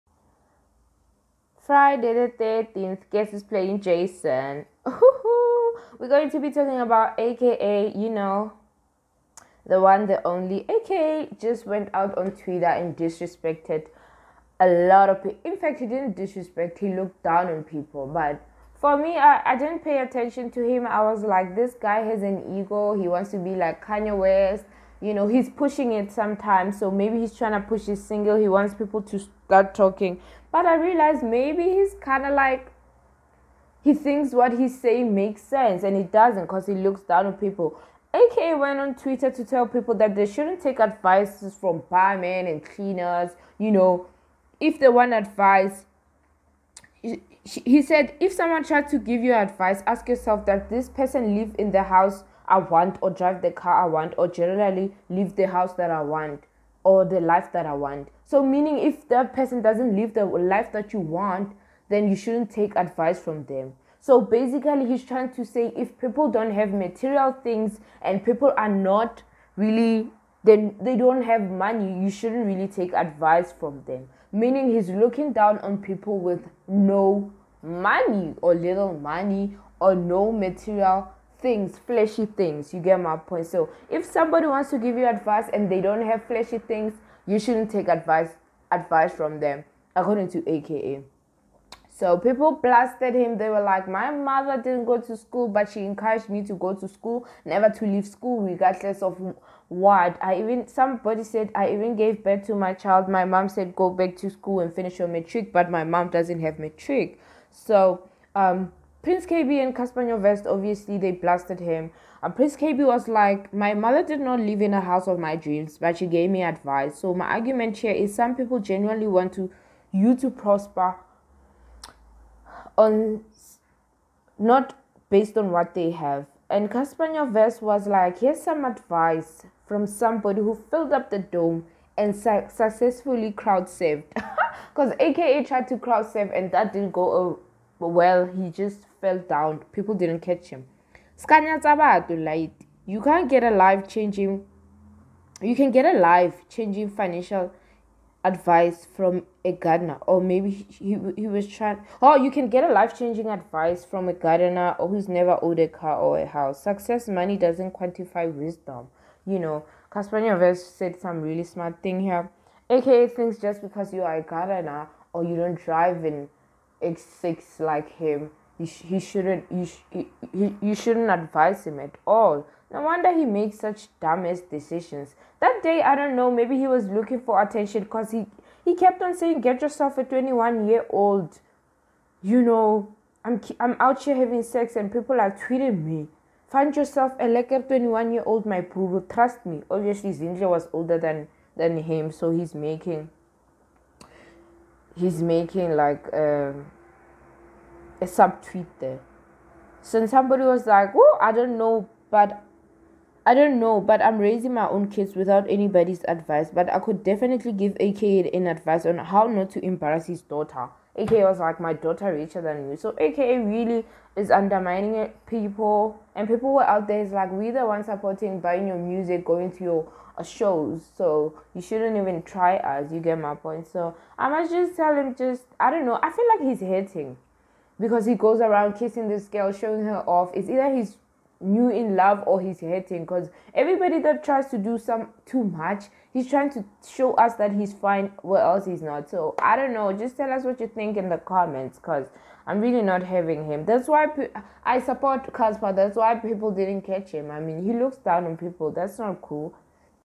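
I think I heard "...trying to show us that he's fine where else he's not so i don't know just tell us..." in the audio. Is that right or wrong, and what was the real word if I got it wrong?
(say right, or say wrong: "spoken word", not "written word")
right.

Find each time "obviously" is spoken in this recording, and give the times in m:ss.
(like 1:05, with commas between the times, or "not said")
1:50, 3:09.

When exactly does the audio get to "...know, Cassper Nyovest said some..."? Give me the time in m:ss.
2:39.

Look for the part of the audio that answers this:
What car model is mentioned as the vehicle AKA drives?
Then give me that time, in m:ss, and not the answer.
2:46.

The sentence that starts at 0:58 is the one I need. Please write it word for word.
So, meaning if that person doesn't live the life that you want, then you shouldn't take advice from them.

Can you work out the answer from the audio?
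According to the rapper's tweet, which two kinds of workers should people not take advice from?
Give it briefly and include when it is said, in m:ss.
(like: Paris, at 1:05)
barmen and cleaners, at 0:41.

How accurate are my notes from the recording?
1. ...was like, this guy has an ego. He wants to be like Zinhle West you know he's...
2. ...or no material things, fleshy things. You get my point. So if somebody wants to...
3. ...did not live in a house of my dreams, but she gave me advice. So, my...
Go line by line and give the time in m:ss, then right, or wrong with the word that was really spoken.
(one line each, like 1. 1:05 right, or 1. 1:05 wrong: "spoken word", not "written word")
1. 0:21 wrong: "Kanye", not "Zinhle"
2. 1:19 right
3. 1:54 right.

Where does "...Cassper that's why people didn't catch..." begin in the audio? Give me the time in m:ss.
4:05.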